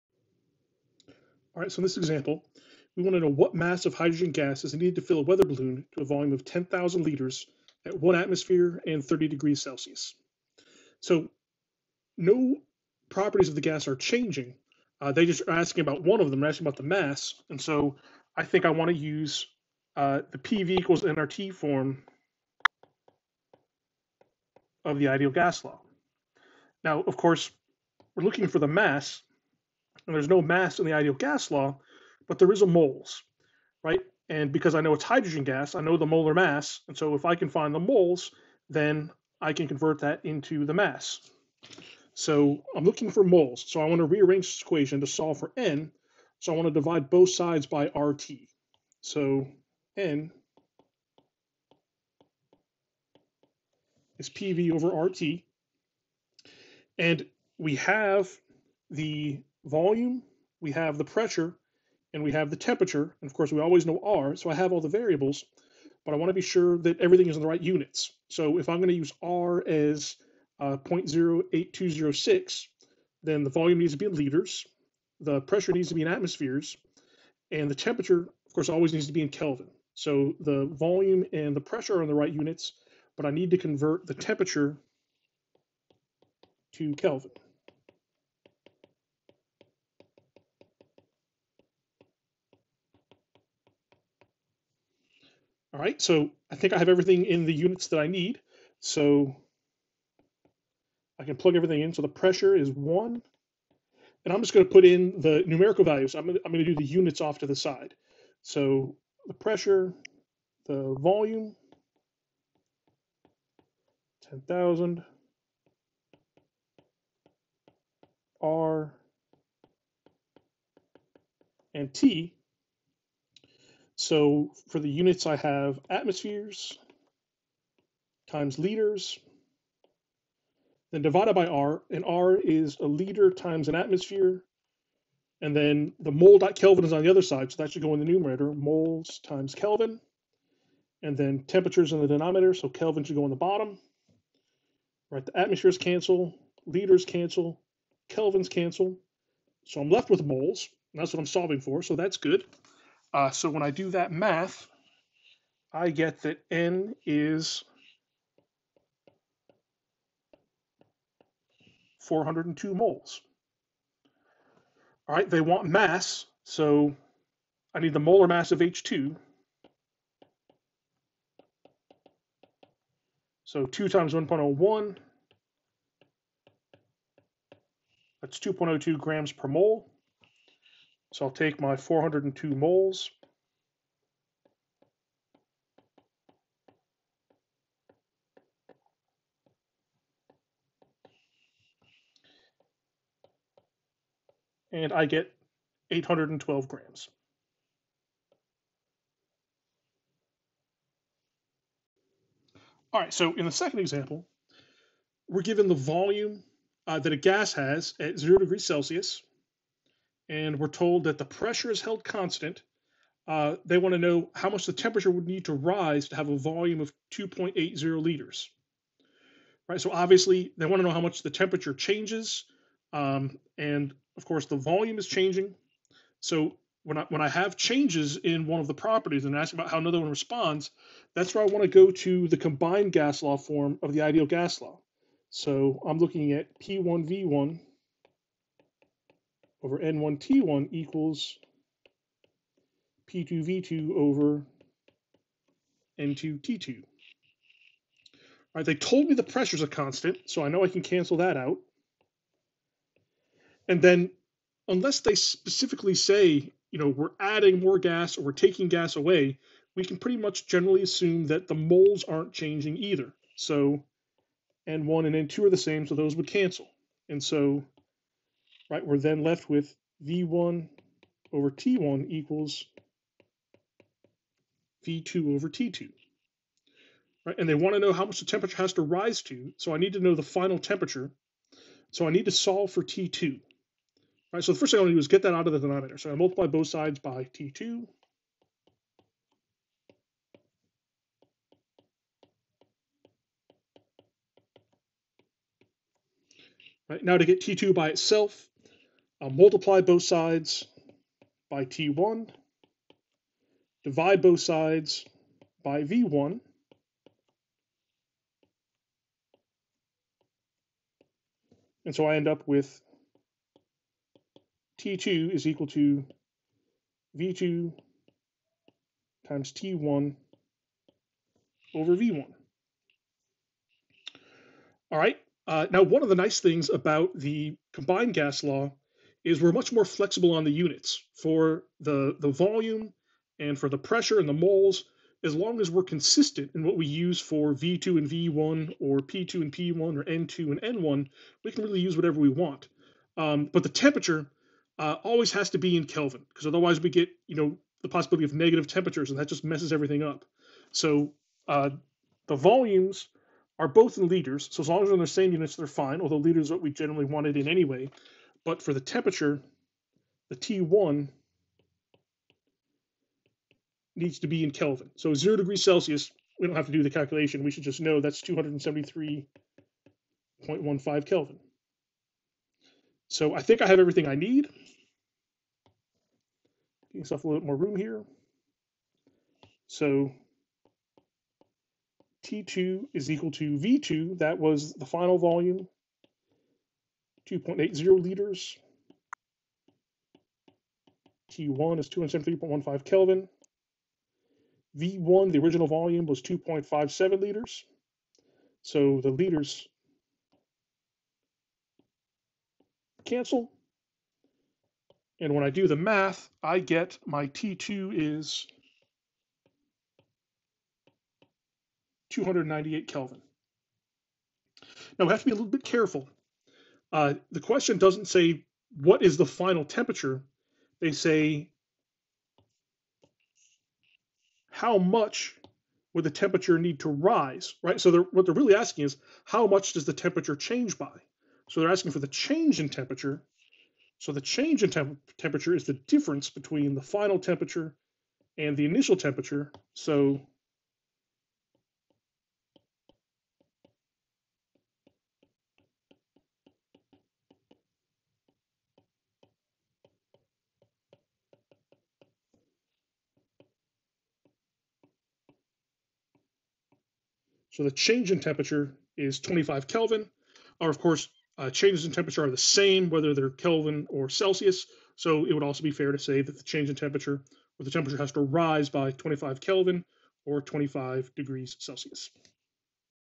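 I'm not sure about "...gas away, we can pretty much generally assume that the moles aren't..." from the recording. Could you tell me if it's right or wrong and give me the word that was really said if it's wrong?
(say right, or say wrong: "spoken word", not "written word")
right.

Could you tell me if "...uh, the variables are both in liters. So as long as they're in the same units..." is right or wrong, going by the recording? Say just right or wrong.
wrong.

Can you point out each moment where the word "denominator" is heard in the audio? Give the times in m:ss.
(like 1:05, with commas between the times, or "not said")
2:22, 4:45.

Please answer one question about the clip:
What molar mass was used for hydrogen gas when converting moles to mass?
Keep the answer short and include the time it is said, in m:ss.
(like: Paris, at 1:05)
2.02 grams per mole, at 2:58.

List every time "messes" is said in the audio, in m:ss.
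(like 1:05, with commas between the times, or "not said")
5:49.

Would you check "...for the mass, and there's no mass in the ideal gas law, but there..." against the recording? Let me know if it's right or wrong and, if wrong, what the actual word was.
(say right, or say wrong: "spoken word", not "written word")
right.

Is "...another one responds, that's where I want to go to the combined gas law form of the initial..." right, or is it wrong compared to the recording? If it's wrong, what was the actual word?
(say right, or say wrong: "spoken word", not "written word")
wrong: "ideal", not "initial".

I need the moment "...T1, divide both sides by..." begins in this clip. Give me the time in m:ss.
5:01.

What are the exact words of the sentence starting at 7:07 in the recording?
So they're, what they're really asking is how much does the temperature change by?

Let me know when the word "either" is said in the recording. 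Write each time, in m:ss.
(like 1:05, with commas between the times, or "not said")
4:22.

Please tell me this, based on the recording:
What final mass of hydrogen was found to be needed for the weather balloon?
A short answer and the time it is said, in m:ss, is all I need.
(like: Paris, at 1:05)
812 grams, at 3:15.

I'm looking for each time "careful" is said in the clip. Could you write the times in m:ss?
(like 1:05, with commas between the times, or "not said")
6:55.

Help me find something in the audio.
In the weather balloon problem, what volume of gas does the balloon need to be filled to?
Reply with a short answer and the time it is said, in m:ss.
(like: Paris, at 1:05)
10,000 liters, at 0:06.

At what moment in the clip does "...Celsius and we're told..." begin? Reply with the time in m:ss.
3:28.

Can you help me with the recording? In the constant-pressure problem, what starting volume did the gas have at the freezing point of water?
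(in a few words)
2.57 liters.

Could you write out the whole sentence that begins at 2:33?
Uh, so when I do that math, I get that n is 402 moles.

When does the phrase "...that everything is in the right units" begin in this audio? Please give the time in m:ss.
1:06.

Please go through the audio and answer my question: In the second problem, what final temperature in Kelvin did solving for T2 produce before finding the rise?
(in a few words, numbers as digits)
298 Kelvin.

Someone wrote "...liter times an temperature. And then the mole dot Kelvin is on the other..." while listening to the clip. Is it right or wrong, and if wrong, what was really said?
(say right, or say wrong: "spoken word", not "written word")
wrong: "atmosphere", not "temperature".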